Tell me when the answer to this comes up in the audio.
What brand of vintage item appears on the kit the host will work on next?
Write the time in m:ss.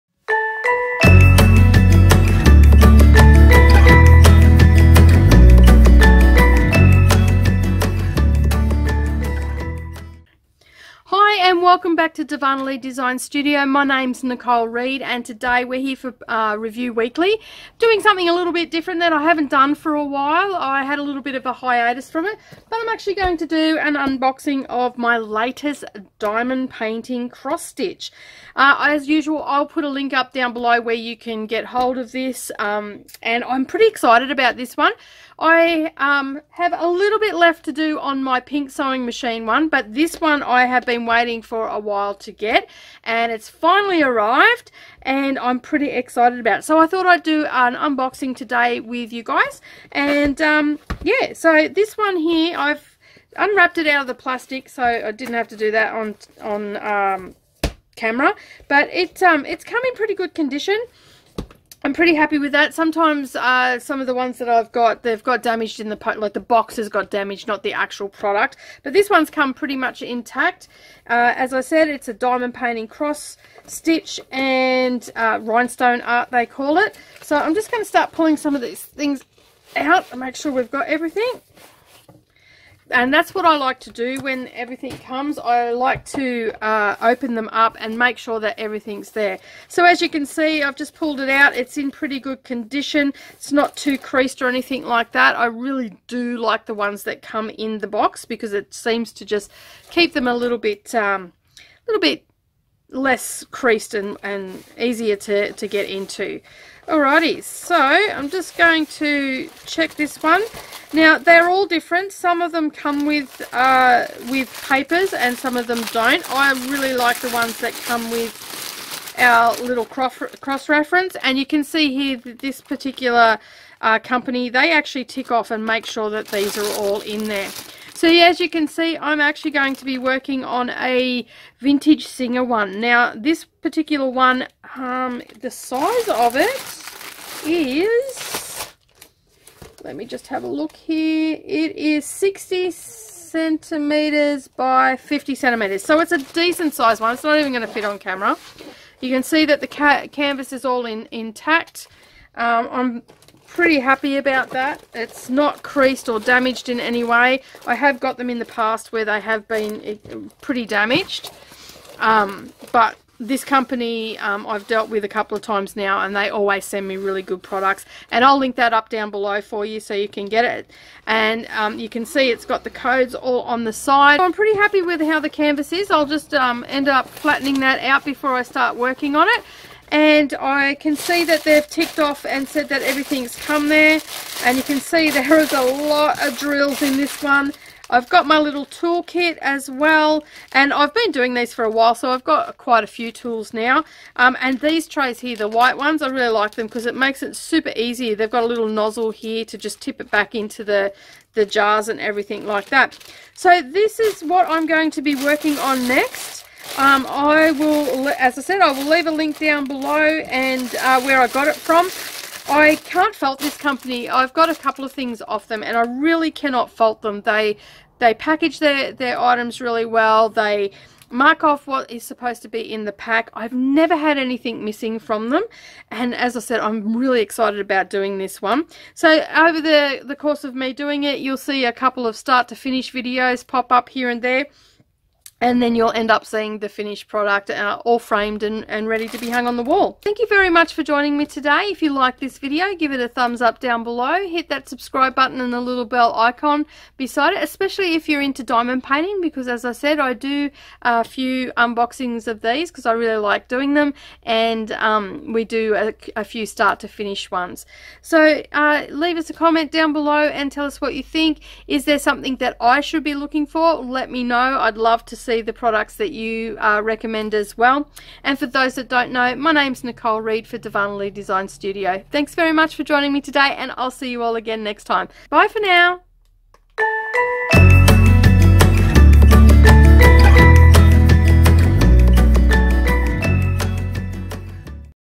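2:12.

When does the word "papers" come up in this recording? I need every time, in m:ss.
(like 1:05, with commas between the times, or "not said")
1:54.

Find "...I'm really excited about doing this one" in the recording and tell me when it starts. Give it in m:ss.
3:46.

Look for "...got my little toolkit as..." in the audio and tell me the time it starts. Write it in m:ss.
3:08.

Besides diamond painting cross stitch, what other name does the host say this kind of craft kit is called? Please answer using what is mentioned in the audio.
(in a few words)
rhinestone art.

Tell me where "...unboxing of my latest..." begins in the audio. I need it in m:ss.
0:23.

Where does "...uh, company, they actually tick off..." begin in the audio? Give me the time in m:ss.
2:03.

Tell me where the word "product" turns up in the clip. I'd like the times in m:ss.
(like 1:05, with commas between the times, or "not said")
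1:08, 2:47, 3:57, 4:25.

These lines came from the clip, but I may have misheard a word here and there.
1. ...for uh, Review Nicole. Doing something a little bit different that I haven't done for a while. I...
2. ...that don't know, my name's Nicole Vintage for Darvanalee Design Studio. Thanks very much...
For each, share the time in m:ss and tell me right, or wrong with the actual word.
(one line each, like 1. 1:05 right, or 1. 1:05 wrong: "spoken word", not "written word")
1. 0:15 wrong: "Weekly", not "Nicole"
2. 4:28 wrong: "Reed", not "Vintage".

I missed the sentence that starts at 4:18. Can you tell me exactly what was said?
So uh, leave us a comment down below and tell us what you think.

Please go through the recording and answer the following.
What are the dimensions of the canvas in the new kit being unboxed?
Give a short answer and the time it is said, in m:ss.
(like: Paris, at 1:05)
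60 cm by 50 cm, at 2:22.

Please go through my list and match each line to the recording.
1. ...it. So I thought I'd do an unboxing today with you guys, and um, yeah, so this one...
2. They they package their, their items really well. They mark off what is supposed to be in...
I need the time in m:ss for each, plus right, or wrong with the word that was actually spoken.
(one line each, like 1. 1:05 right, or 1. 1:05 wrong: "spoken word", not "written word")
1. 0:46 right
2. 3:37 right.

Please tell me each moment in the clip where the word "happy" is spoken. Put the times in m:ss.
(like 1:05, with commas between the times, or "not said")
1:02, 2:33, 2:54.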